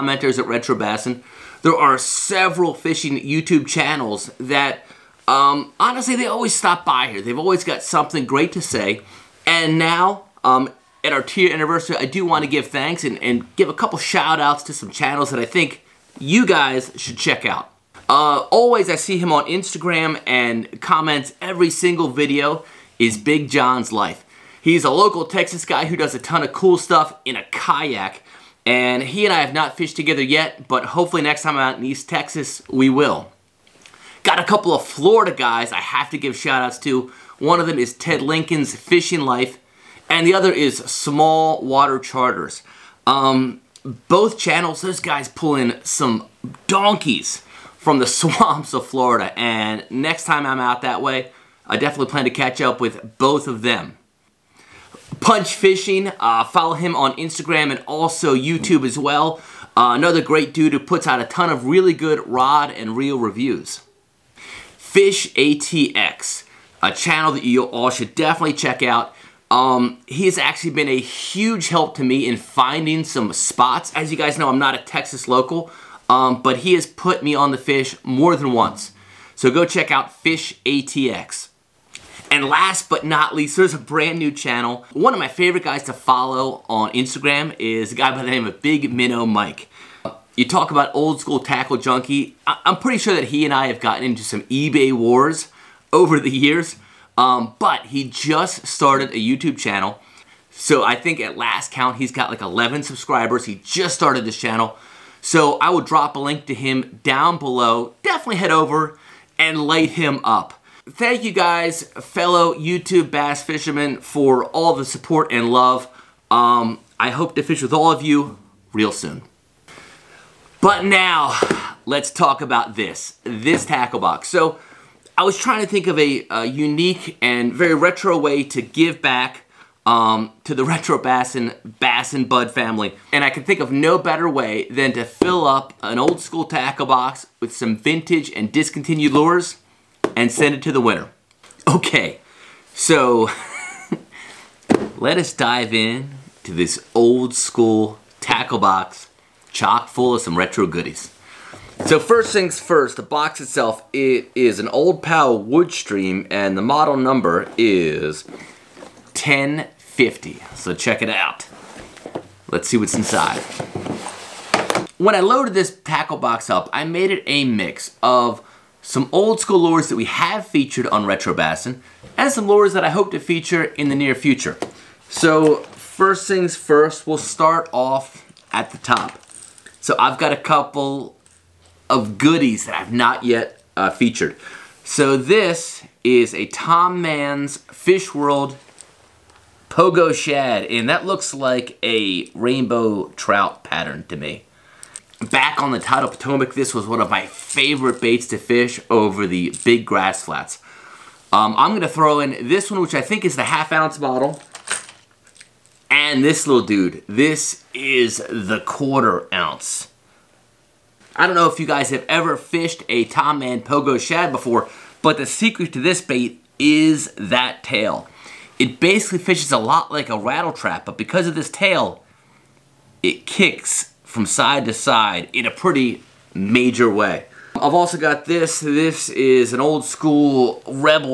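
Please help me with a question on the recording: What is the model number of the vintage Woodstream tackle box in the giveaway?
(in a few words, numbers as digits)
1050.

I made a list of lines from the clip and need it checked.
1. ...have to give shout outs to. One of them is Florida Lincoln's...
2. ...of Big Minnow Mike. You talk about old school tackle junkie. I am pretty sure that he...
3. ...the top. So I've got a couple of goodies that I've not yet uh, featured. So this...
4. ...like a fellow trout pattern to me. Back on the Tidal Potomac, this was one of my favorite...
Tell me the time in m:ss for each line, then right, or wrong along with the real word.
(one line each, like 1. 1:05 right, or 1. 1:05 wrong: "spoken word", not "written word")
1. 0:35 wrong: "Ted", not "Florida"
2. 1:28 right
3. 2:58 right
4. 3:11 wrong: "rainbow", not "fellow".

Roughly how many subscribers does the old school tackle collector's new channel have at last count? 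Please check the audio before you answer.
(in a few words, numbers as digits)
11.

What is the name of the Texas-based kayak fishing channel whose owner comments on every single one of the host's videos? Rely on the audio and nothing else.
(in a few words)
Big John's life.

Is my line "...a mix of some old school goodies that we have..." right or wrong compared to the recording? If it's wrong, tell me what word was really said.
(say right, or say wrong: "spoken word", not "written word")
wrong: "lures", not "goodies".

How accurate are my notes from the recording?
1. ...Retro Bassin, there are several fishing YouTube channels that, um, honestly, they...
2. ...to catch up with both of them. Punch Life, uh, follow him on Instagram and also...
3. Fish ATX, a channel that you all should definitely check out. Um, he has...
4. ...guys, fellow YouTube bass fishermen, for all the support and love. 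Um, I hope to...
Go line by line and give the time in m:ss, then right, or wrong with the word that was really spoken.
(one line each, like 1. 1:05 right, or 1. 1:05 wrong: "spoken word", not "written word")
1. 0:00 right
2. 0:52 wrong: "Fishing", not "Life"
3. 1:04 right
4. 1:51 right.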